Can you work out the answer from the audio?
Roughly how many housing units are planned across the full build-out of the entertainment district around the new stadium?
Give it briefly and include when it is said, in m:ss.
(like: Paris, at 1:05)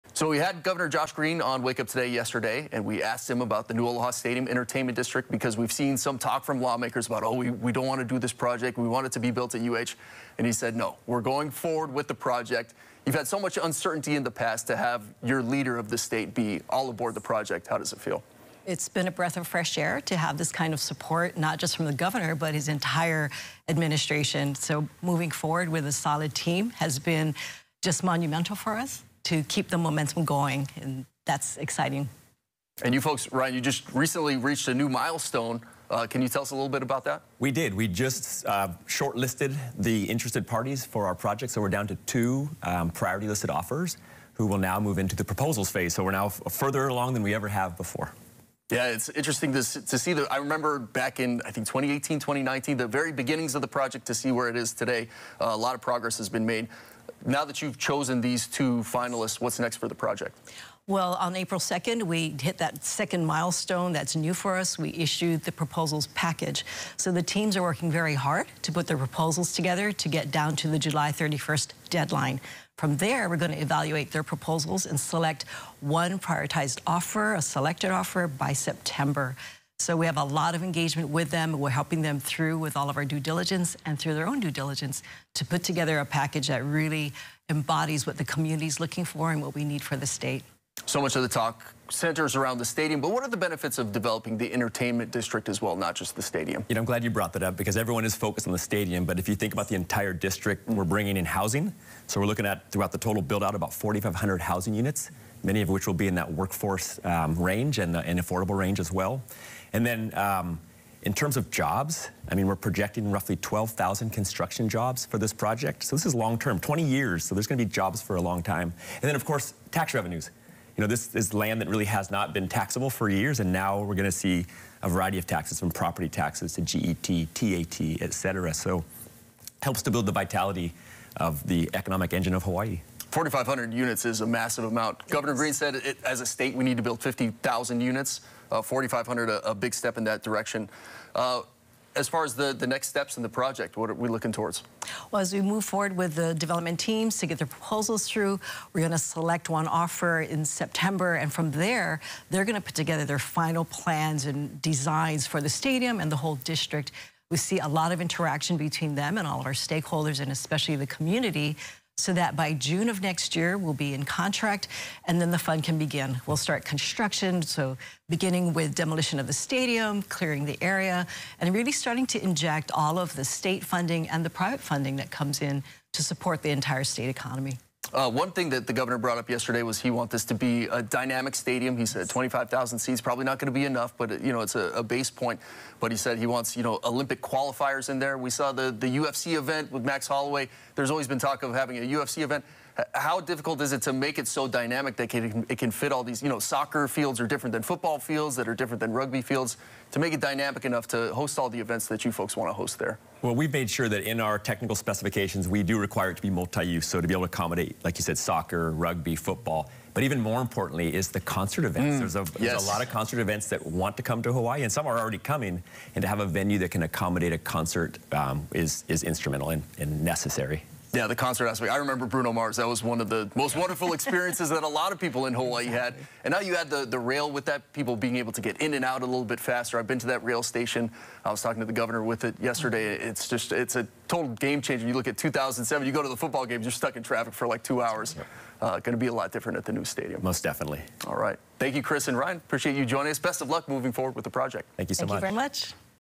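4,500, at 1:43.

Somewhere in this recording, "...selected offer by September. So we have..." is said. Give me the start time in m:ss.
1:17.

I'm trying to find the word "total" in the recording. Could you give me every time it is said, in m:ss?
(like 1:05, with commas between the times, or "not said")
1:42, 3:54.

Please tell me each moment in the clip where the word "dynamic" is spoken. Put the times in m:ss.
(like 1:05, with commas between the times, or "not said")
3:00, 3:14, 3:20.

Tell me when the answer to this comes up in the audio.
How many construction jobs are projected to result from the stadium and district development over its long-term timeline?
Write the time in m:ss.
1:53.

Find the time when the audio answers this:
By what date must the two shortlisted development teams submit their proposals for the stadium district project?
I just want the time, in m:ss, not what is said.
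1:10.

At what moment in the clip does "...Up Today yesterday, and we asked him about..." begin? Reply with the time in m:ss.
0:01.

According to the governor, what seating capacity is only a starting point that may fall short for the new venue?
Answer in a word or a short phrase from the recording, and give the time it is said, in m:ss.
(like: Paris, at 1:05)
25,000, at 3:02.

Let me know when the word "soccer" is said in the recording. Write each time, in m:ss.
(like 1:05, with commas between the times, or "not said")
3:16, 3:28.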